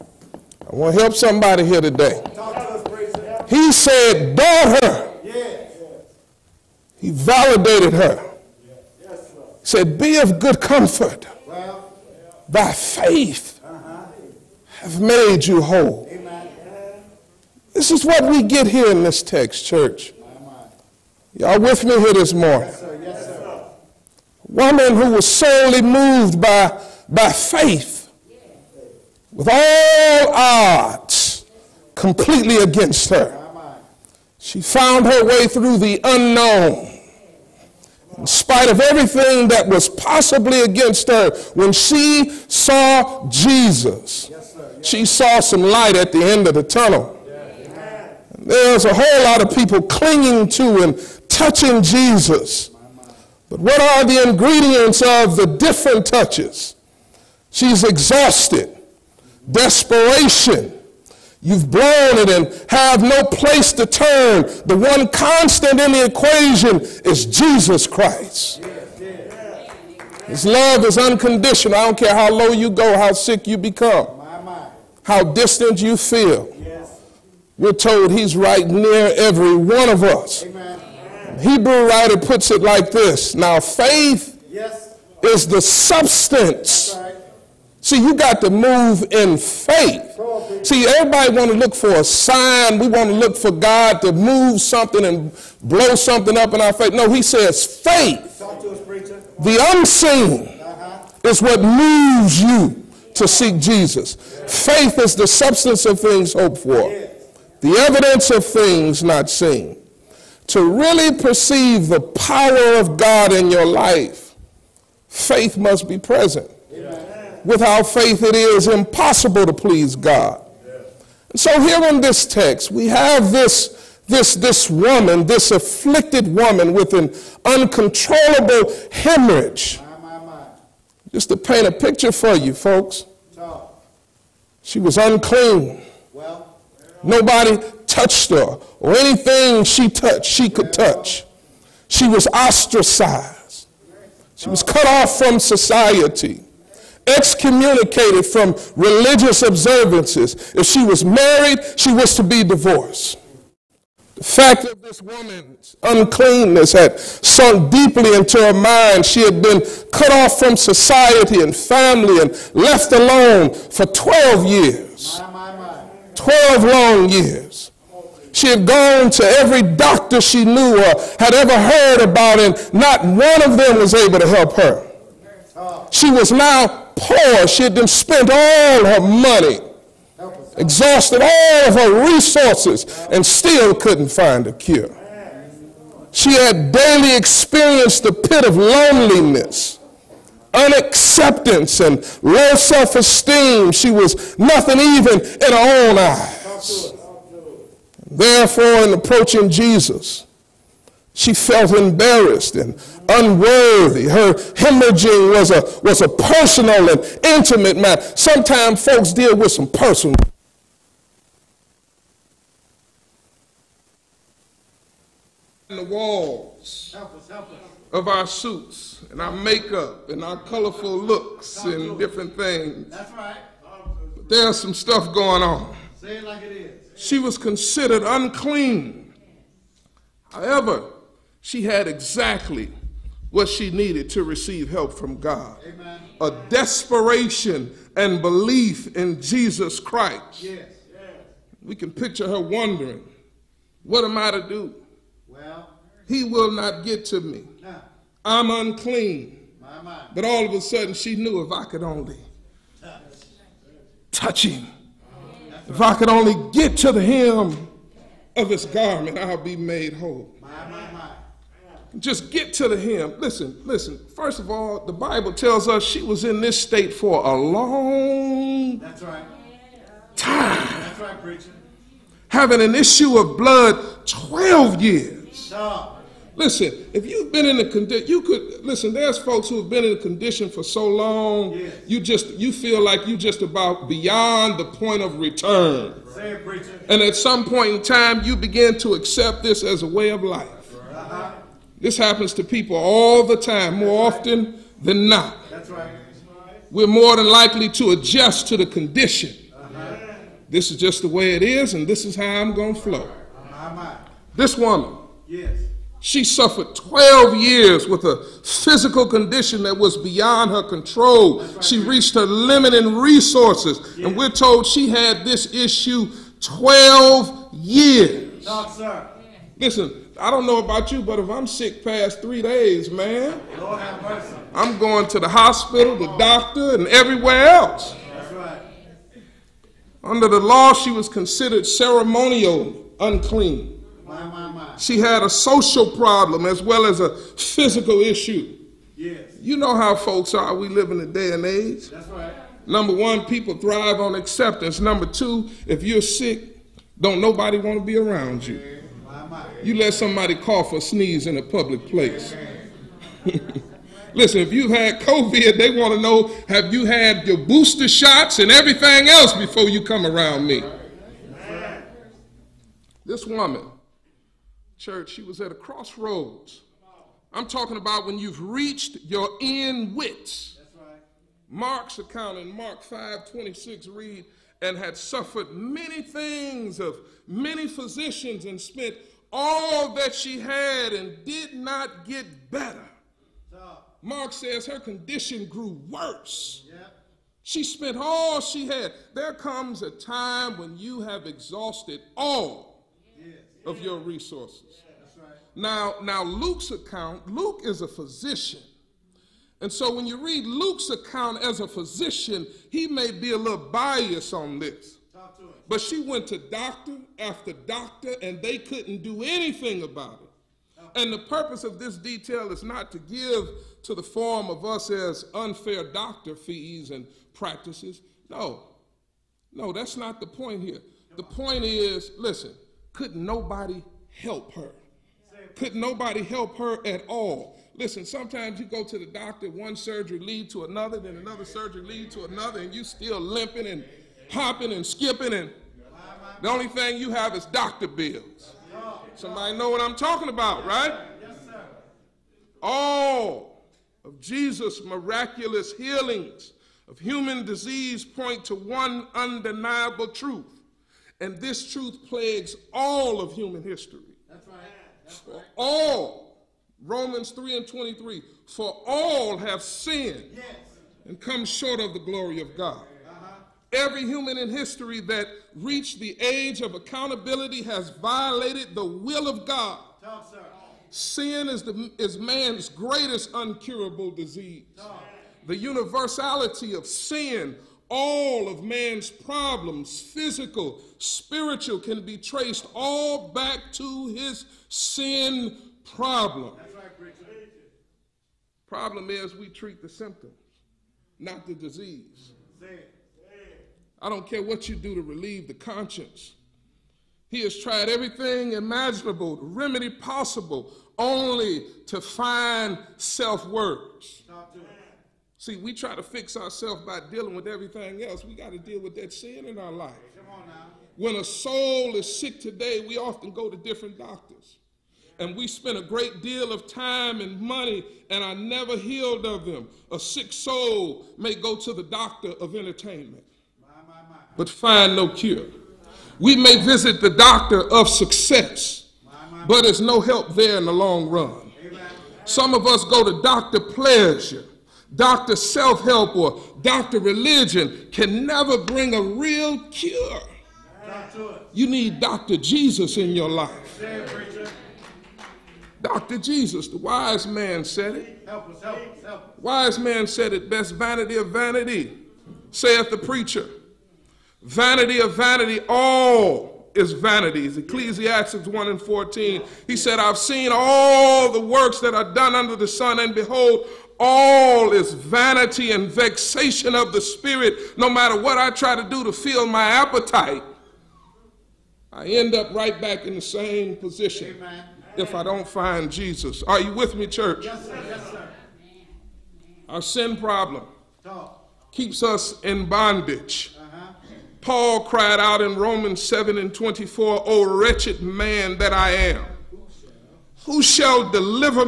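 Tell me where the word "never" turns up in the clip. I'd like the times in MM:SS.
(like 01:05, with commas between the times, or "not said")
08:38, 08:58.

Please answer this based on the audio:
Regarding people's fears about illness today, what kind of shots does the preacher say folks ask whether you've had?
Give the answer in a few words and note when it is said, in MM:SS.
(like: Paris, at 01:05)
Booster shots, at 05:57.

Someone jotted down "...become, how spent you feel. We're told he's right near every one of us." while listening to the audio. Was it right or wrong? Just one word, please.
wrong.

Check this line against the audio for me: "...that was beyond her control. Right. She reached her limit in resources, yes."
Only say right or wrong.
right.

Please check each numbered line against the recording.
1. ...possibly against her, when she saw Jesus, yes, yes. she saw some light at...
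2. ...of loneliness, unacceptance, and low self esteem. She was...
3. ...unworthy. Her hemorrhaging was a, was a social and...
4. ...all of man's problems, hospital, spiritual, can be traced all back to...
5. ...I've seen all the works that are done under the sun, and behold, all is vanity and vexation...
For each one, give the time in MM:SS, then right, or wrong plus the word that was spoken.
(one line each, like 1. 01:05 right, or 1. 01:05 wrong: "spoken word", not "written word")
1. 00:39 right
2. 03:08 right
3. 03:23 wrong: "personal", not "social"
4. 07:57 wrong: "physical", not "hospital"
5. 09:19 right.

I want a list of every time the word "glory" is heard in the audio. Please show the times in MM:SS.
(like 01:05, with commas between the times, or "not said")
07:41.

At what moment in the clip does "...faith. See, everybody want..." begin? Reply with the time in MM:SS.
01:29.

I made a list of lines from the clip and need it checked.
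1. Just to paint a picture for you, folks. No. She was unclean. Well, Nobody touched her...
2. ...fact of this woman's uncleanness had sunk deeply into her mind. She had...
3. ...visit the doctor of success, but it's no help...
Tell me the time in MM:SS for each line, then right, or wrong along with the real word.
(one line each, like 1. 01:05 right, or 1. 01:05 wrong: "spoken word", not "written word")
1. 02:11 right
2. 02:34 right
3. 08:46 right.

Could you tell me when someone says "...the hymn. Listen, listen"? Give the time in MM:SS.
04:22.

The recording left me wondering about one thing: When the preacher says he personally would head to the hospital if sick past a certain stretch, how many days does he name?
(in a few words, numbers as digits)
3.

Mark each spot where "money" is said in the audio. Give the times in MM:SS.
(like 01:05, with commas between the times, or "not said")
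02:58, 08:37.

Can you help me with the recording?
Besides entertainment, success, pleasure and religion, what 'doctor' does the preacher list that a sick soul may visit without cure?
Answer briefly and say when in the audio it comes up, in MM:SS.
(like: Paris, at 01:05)
Doctor self help, at 08:54.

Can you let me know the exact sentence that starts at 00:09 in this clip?
He said, be of good comfort.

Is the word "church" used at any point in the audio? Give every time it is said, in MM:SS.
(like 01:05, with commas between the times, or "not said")
00:19, 06:04, 09:37.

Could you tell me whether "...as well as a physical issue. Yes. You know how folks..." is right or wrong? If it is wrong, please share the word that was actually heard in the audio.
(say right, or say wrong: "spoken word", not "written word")
right.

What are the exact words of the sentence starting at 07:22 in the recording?
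All of Jesus' miraculous healings of human disease point to one undeniable truth, and this truth plagues all of human history.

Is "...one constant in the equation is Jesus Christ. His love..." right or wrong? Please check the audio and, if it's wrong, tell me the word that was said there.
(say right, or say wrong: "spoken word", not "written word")
right.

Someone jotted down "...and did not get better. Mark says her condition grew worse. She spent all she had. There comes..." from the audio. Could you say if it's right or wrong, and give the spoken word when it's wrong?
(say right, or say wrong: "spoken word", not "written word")
right.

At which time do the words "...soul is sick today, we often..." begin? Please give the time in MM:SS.
08:31.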